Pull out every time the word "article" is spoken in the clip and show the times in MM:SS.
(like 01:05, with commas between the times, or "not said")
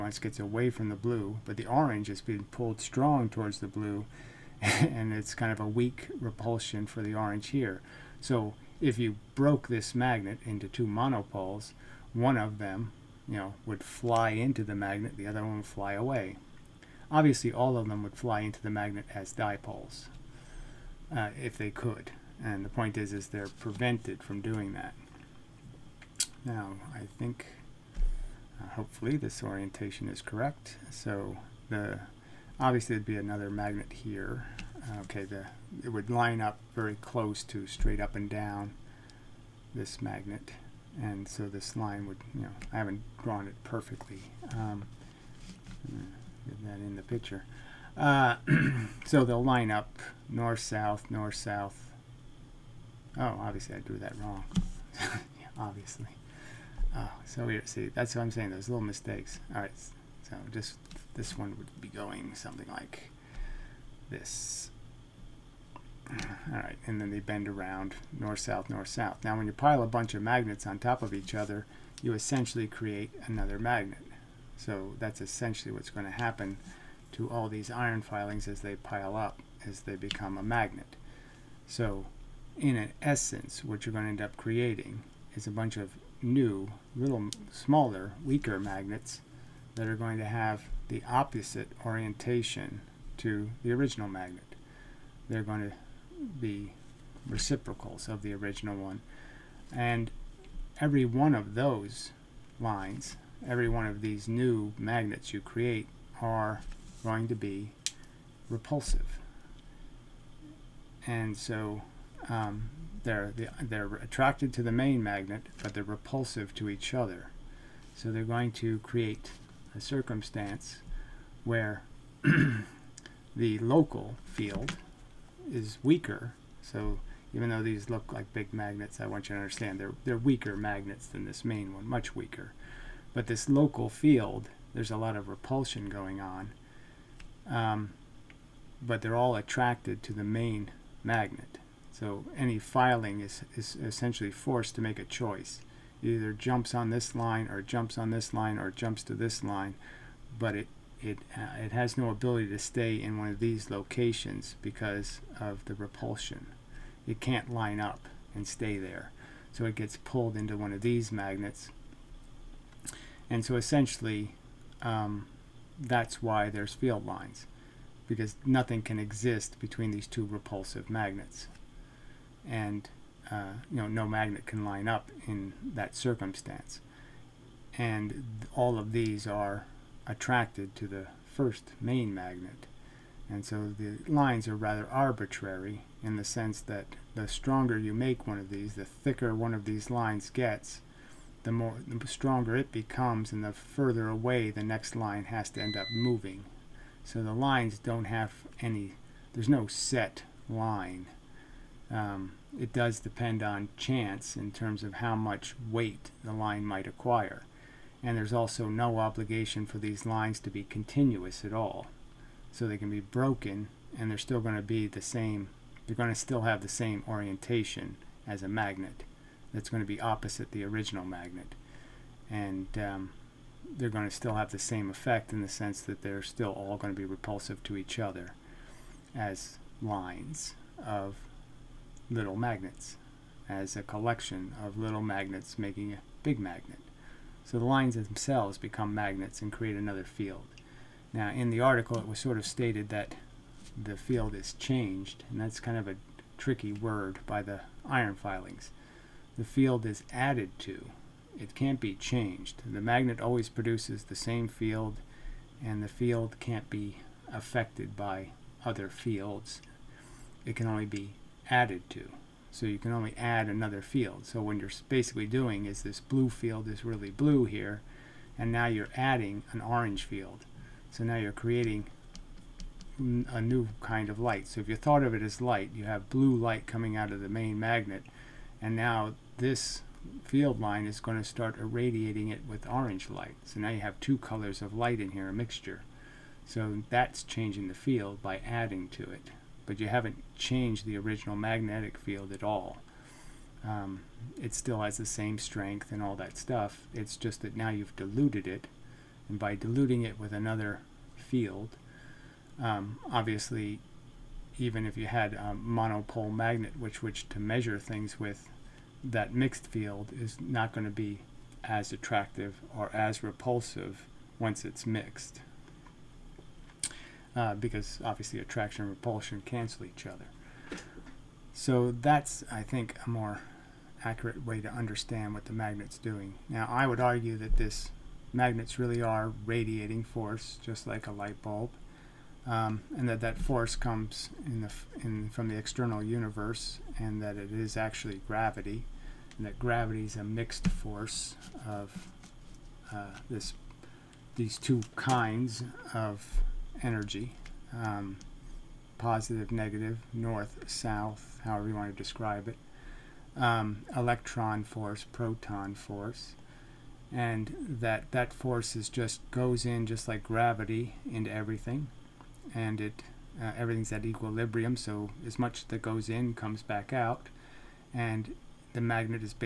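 04:01.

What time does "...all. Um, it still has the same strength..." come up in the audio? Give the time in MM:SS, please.
04:52.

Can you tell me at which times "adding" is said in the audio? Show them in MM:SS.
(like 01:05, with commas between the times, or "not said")
04:28, 04:48.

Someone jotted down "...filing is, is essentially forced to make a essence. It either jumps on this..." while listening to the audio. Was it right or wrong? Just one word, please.
wrong.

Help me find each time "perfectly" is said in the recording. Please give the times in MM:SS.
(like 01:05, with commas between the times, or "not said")
00:43.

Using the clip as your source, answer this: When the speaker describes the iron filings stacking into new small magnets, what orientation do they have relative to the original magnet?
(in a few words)
the opposite orientation.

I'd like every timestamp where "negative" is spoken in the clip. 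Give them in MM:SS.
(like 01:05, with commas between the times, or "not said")
05:49.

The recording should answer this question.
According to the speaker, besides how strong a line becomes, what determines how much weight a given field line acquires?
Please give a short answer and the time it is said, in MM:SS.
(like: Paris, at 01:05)
chance, at 03:23.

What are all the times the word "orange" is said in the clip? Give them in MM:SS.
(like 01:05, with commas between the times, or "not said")
00:01, 00:07, 04:29, 04:42.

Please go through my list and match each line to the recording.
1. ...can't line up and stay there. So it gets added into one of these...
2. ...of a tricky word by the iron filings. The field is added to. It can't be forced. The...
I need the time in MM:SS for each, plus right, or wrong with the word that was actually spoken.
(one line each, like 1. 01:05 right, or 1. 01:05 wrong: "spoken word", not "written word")
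1. 02:37 wrong: "pulled", not "added"
2. 04:05 wrong: "changed", not "forced".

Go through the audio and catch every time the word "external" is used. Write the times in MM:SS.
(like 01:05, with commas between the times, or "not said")
05:35.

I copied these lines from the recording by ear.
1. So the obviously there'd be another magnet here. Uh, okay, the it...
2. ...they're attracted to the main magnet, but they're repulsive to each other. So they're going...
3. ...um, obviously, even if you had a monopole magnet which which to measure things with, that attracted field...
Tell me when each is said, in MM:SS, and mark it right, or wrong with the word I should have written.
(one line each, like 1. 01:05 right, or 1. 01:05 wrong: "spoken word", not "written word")
1. 00:30 right
2. 01:53 right
3. 05:02 wrong: "mixed", not "attracted".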